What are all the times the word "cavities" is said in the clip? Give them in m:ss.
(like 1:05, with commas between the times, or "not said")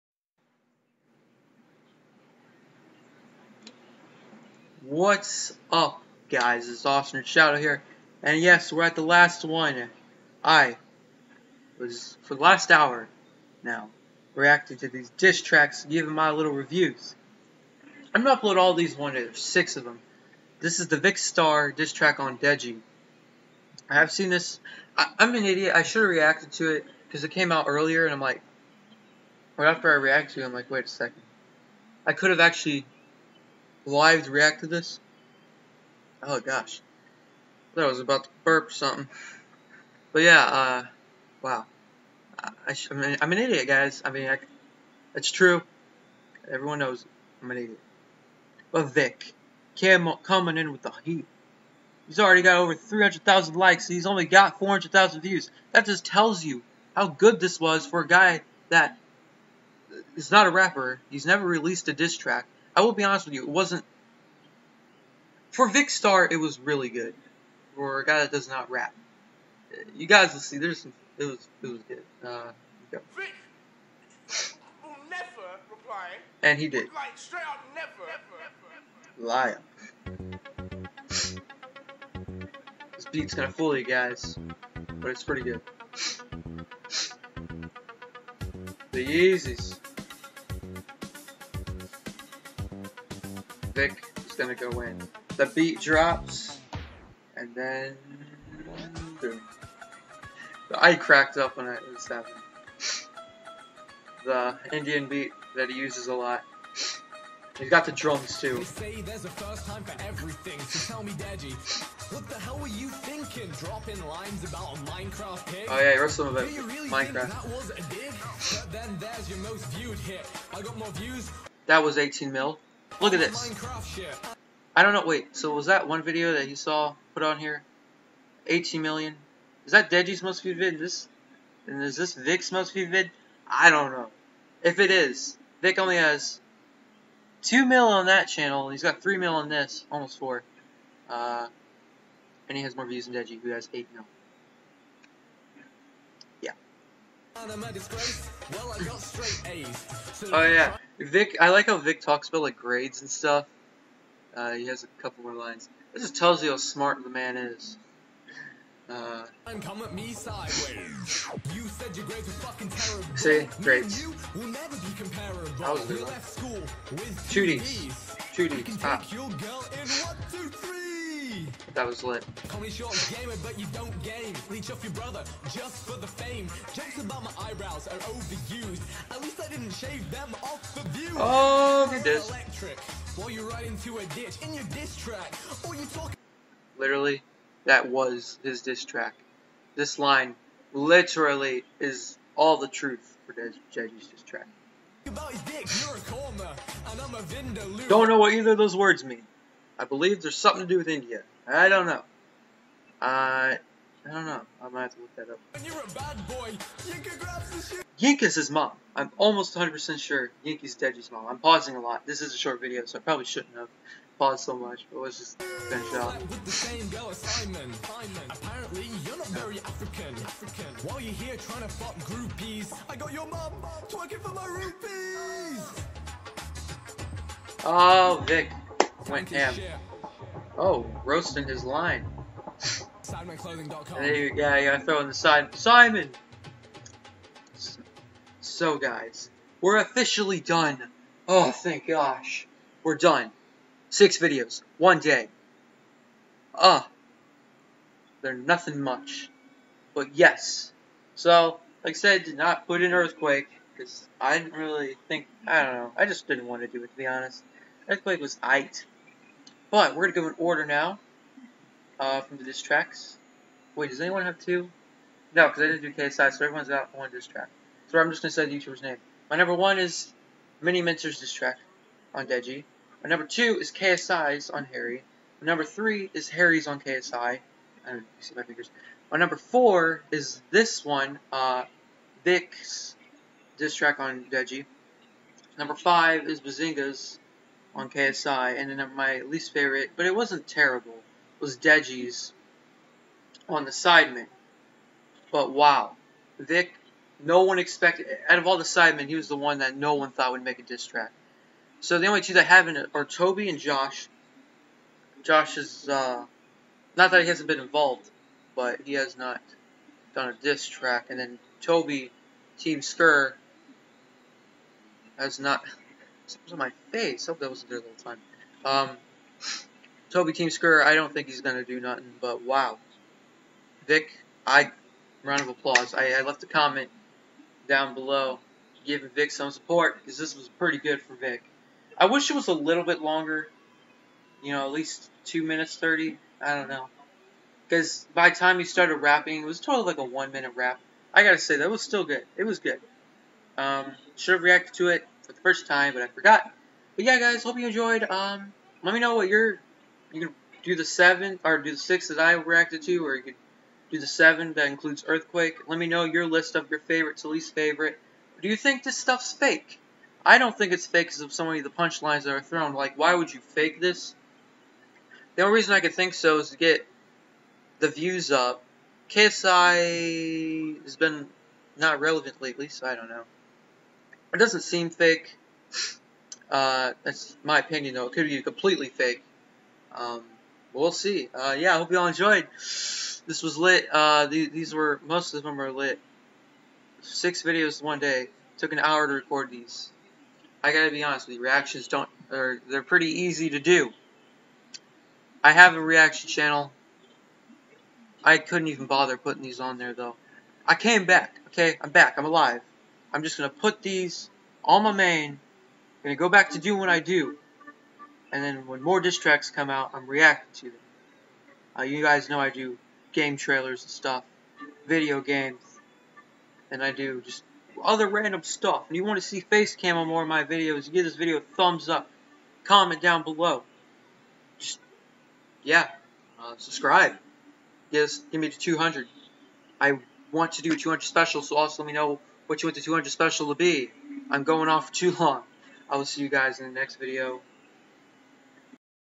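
not said.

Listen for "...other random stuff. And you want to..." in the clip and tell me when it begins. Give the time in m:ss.
6:57.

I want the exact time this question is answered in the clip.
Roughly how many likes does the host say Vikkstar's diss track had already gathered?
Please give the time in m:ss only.
0:52.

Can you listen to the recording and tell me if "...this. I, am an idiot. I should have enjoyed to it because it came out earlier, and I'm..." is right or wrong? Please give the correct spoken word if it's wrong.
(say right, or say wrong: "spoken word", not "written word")
wrong: "reacted", not "enjoyed".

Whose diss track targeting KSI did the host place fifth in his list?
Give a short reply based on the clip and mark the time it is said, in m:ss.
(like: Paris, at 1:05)
Bazinga, at 4:46.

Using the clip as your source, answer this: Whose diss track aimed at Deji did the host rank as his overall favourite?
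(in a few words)
Miniminter.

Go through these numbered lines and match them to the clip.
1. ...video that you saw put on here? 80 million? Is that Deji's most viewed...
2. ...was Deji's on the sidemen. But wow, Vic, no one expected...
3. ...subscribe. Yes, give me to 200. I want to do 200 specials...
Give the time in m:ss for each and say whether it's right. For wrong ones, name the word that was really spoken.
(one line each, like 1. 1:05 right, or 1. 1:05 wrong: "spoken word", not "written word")
1. 2:06 right
2. 4:51 right
3. 7:06 right.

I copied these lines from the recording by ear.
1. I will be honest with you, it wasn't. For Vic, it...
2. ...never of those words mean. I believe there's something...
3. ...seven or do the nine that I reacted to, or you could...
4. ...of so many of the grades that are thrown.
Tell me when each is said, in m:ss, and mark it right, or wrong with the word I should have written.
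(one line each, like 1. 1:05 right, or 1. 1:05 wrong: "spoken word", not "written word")
1. 1:02 wrong: "Vikkstar", not "Vic"
2. 3:18 wrong: "either", not "never"
3. 5:50 wrong: "six", not "nine"
4. 6:01 wrong: "punchlines", not "grades".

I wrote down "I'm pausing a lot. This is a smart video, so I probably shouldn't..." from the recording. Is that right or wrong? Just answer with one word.
wrong.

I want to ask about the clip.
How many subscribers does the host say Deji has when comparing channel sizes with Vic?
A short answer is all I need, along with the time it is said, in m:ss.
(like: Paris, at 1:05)
8 mil, at 2:23.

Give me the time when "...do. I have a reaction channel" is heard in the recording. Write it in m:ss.
6:33.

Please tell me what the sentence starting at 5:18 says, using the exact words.
Um, Toby Teamsker, I don't think he's going to do nothing, but wow.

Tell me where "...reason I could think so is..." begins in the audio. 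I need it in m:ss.
6:05.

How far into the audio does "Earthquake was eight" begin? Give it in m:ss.
4:17.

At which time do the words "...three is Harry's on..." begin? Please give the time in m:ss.
4:35.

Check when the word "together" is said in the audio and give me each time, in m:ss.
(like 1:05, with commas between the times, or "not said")
not said.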